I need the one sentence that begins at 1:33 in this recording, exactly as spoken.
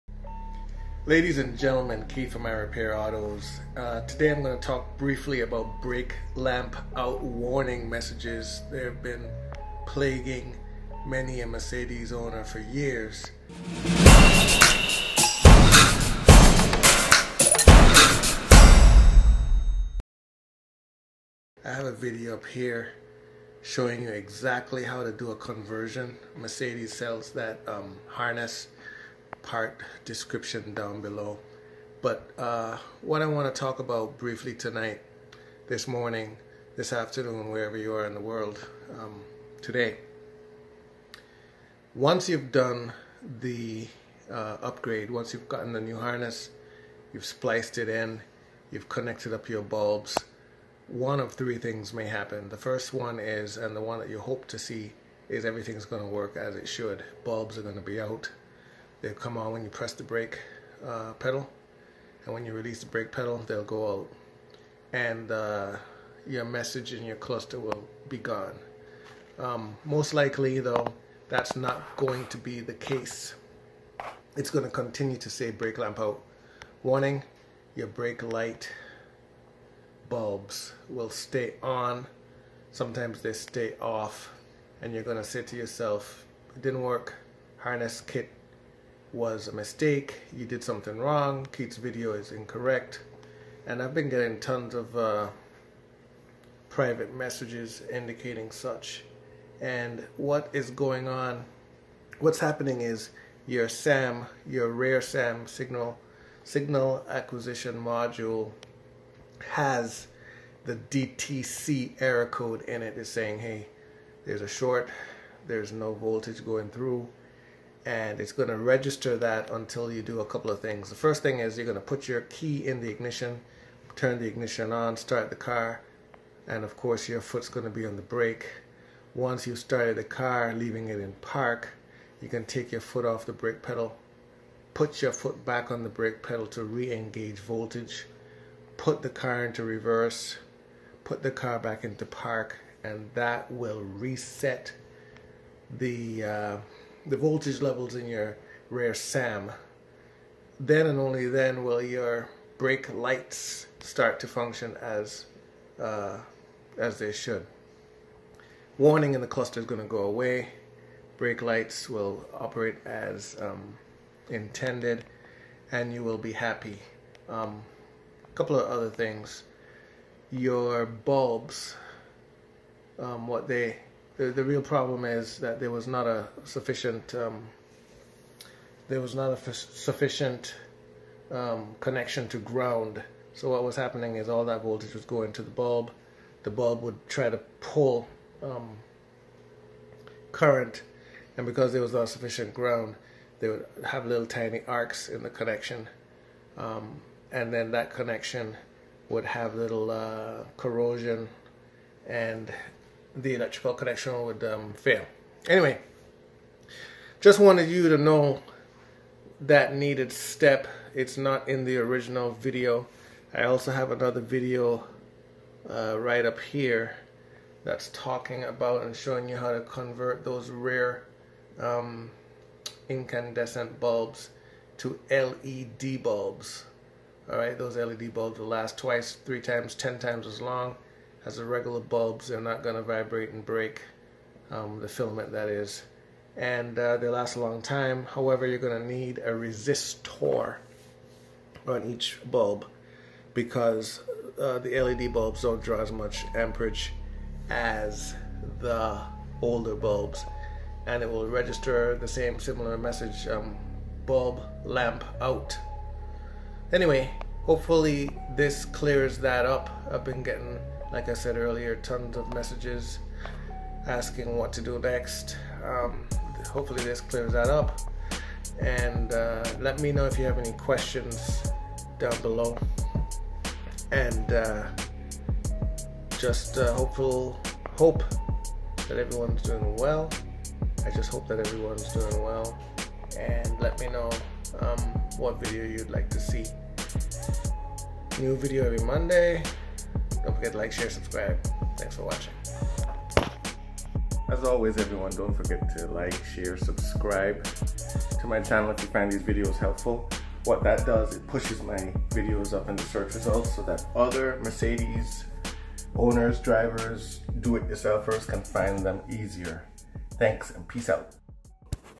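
And I've been getting tons of uh, private messages indicating such.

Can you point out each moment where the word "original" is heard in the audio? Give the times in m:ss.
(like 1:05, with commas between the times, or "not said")
3:31.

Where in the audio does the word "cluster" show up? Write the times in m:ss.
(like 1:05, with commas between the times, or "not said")
1:07, 2:39.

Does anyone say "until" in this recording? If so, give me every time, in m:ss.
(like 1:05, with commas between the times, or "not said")
1:59.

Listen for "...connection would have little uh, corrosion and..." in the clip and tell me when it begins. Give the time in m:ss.
3:17.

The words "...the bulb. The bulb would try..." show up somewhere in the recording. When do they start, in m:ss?
3:05.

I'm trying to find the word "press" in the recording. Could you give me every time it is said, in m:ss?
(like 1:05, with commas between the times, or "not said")
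0:59.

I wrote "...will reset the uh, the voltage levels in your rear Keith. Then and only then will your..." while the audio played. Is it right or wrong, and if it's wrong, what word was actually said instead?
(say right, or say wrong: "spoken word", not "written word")
wrong: "SAM", not "Keith".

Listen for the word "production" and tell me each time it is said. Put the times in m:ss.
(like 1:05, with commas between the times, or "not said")
not said.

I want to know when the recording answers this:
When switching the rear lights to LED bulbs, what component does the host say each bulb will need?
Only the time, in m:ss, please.
3:59.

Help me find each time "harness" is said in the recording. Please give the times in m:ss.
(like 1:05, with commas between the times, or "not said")
0:28, 0:45, 1:27.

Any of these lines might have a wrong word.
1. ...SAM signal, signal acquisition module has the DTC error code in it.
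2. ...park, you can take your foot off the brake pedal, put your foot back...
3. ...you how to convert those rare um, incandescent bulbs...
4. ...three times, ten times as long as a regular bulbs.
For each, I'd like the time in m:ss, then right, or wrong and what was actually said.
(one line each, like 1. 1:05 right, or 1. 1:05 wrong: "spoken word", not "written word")
1. 1:45 right
2. 2:11 right
3. 3:39 right
4. 3:49 right.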